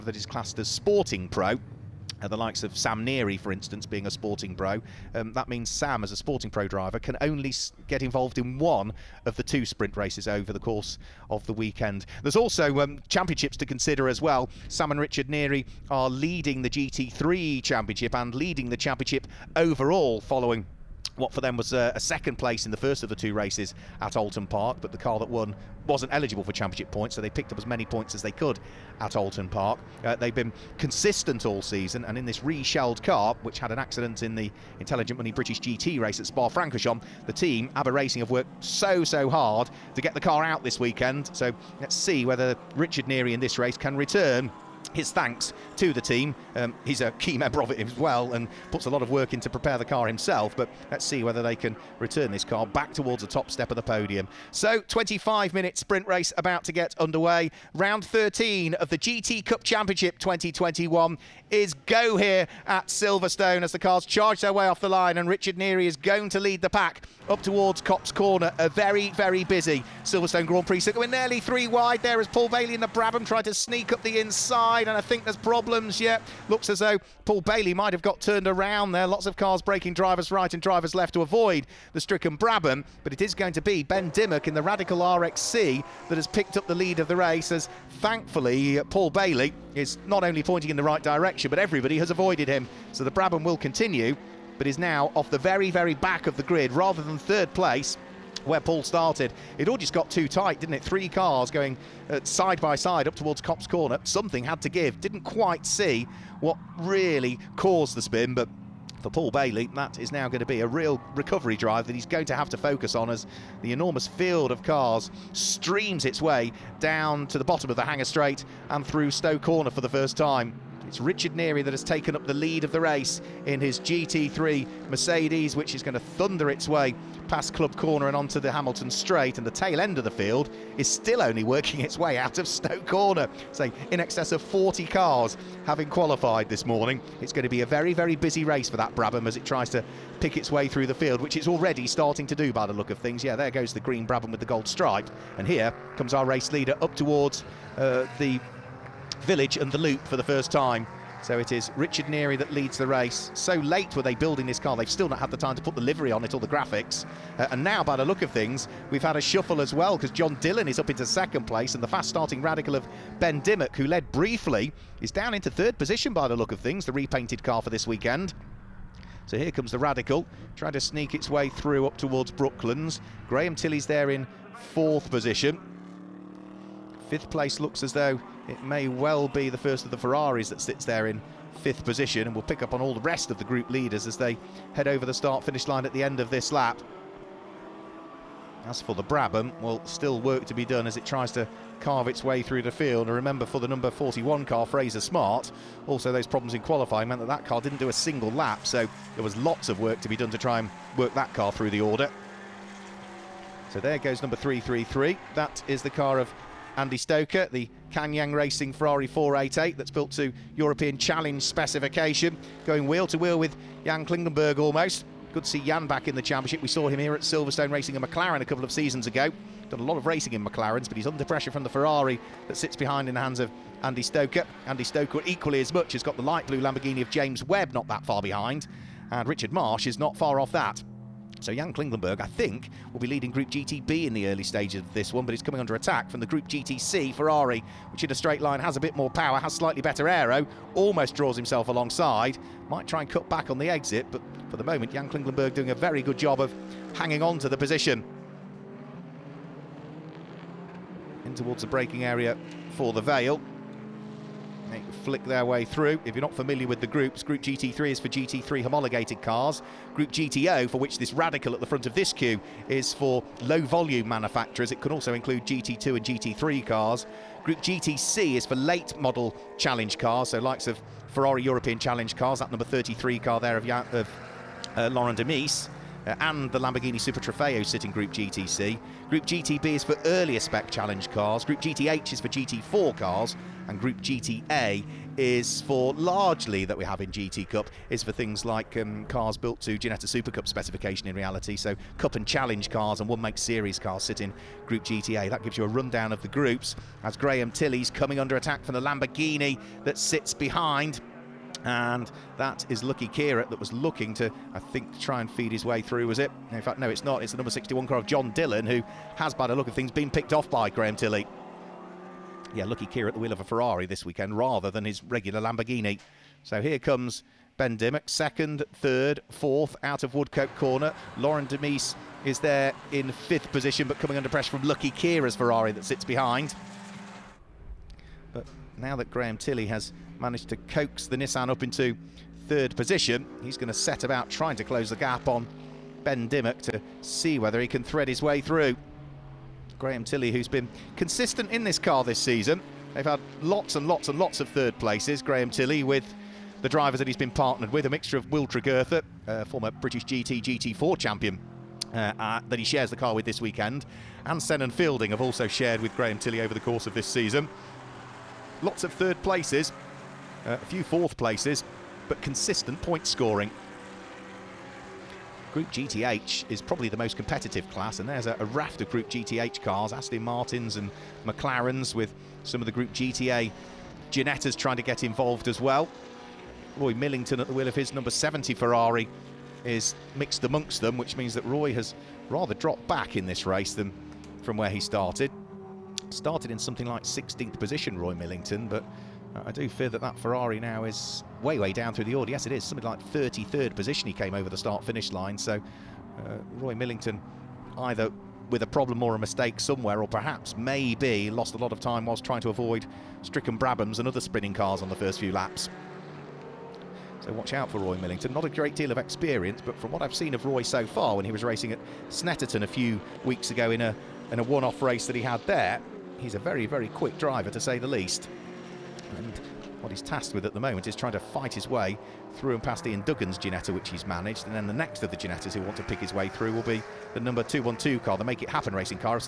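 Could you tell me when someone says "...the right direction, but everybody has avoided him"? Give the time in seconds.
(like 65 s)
90 s.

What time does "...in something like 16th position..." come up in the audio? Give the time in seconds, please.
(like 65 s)
386 s.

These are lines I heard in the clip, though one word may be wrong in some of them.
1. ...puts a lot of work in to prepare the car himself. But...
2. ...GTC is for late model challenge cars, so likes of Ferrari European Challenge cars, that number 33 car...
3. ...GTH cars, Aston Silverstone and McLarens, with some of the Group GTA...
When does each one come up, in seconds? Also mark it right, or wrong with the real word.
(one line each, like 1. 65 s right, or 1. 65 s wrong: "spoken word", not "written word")
1. 48 s right
2. 267 s right
3. 369 s wrong: "Martins", not "Silverstone".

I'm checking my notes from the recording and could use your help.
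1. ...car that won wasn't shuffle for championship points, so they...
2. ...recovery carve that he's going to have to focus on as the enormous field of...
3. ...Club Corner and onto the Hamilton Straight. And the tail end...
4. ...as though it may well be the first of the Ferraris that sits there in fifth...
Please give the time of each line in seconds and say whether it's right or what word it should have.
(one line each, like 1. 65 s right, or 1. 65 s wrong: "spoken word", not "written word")
1. 24 s wrong: "eligible", not "shuffle"
2. 111 s wrong: "drive", not "carve"
3. 127 s right
4. 177 s right.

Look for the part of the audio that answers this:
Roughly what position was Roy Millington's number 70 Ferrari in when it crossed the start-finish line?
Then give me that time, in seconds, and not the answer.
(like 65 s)
393 s.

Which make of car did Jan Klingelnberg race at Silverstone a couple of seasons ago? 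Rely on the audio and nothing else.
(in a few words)
McLaren.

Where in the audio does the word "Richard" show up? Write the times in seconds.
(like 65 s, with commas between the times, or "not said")
14 s, 42 s, 65 s, 121 s, 151 s, 229 s.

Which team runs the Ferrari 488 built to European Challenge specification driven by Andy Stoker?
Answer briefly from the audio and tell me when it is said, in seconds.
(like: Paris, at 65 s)
Kanyang Racing, at 207 s.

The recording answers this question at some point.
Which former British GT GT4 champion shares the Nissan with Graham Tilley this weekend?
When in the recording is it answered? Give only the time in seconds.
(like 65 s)
348 s.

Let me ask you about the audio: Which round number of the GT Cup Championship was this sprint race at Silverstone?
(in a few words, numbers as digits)
13.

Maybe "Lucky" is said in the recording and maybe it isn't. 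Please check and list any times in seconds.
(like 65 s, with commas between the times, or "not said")
302 s, 312 s, 324 s.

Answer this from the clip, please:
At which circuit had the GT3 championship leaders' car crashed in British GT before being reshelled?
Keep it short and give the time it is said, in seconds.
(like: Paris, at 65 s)
Spa-Francorchamps, at 36 s.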